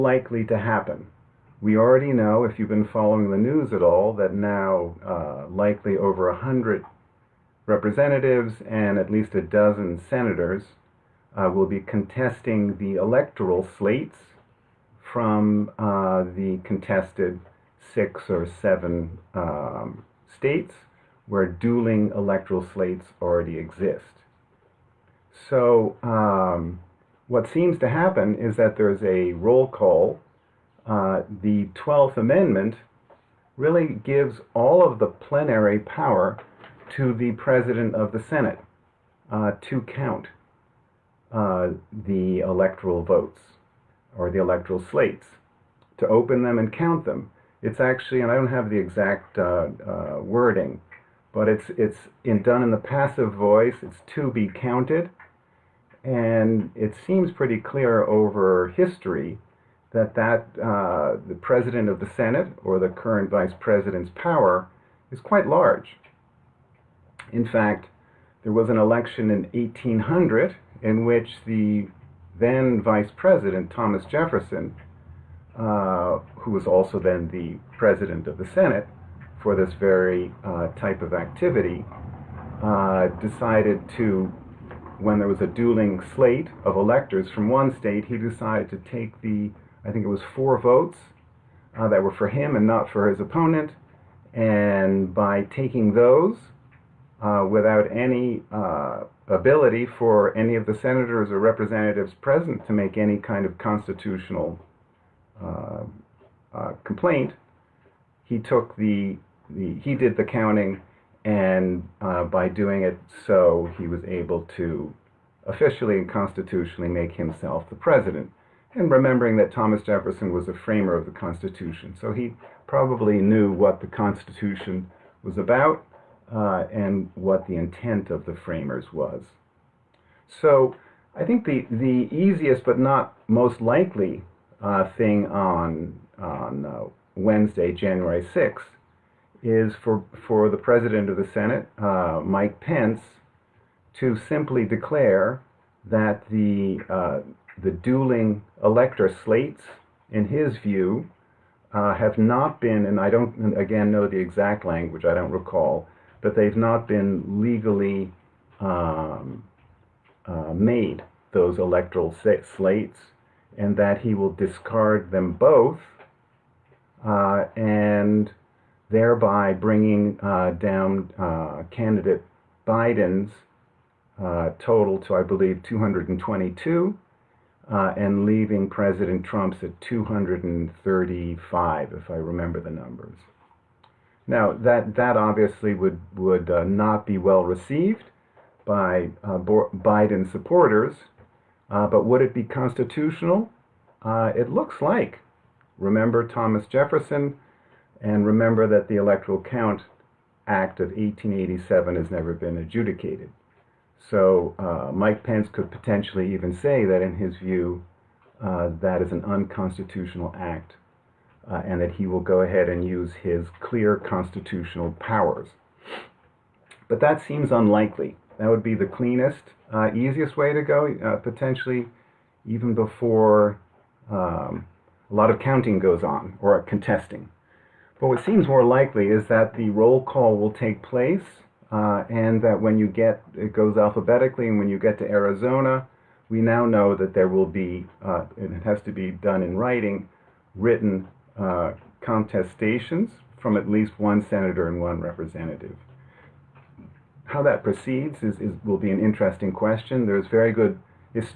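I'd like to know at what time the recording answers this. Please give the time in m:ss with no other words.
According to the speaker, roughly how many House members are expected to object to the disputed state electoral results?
0:05.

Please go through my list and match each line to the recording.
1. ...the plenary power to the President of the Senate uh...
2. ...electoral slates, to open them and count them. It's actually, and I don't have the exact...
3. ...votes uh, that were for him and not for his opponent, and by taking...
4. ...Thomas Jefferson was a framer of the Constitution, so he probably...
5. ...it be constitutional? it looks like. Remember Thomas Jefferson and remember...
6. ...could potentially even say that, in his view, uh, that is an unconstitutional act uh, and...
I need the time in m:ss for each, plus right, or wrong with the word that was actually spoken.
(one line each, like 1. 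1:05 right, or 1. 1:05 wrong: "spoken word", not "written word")
1. 0:34 right
2. 0:44 right
3. 1:30 right
4. 1:59 right
5. 3:12 right
6. 3:25 right.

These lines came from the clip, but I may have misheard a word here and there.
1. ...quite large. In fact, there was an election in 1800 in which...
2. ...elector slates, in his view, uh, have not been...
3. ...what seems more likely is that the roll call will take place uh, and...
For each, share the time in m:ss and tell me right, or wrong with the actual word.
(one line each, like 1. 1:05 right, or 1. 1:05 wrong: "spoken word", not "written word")
1. 1:05 right
2. 2:28 right
3. 3:48 right.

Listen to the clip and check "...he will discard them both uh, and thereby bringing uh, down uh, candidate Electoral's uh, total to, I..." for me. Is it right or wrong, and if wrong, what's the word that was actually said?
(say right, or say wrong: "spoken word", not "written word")
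wrong: "Biden", not "Electoral".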